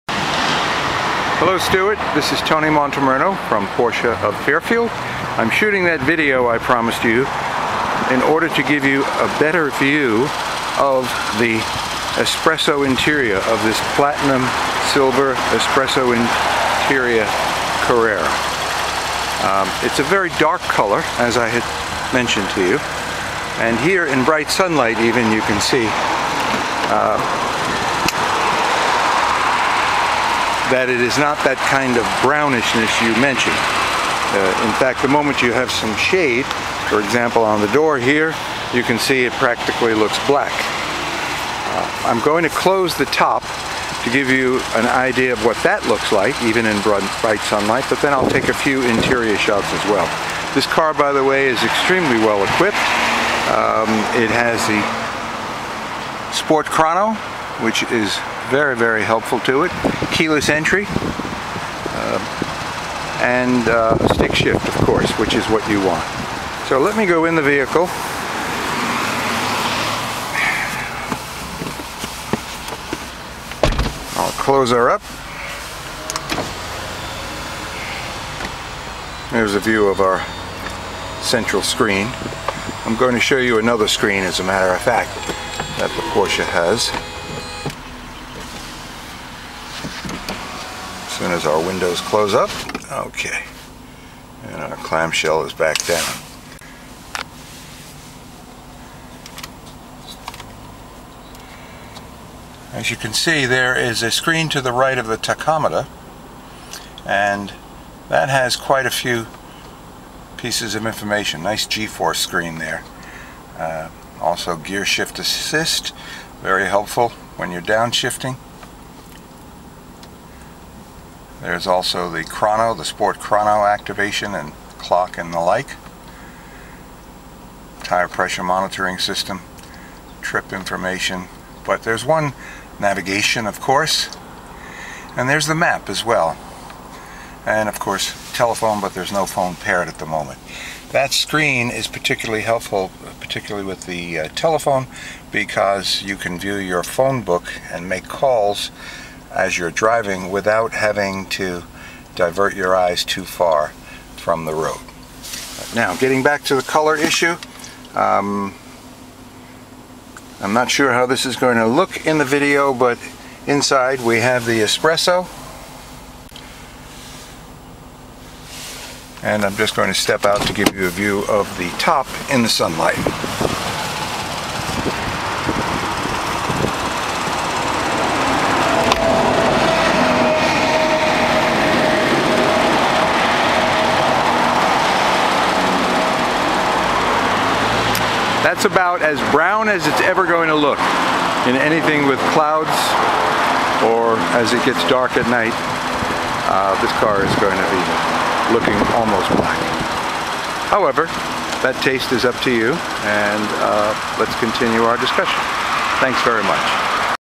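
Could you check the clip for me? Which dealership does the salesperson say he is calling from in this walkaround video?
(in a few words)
Porsche of Fairfield.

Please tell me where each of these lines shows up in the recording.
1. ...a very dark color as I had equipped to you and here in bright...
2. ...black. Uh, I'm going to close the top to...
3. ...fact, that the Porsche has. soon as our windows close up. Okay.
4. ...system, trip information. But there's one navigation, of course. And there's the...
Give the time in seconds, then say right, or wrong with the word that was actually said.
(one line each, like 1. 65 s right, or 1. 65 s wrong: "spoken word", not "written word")
1. 19 s wrong: "mentioned", not "equipped"
2. 40 s right
3. 84 s right
4. 128 s right.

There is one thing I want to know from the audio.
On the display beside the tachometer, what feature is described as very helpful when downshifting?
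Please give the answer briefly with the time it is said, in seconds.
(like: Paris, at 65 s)
Gear shift assist, at 114 s.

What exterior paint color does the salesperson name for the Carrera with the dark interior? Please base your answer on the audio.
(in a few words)
Platinum silver.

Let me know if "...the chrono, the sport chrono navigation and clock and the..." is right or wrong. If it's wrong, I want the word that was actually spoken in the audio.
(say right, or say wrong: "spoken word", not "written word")
wrong: "activation", not "navigation".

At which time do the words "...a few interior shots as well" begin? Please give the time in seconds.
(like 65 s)
48 s.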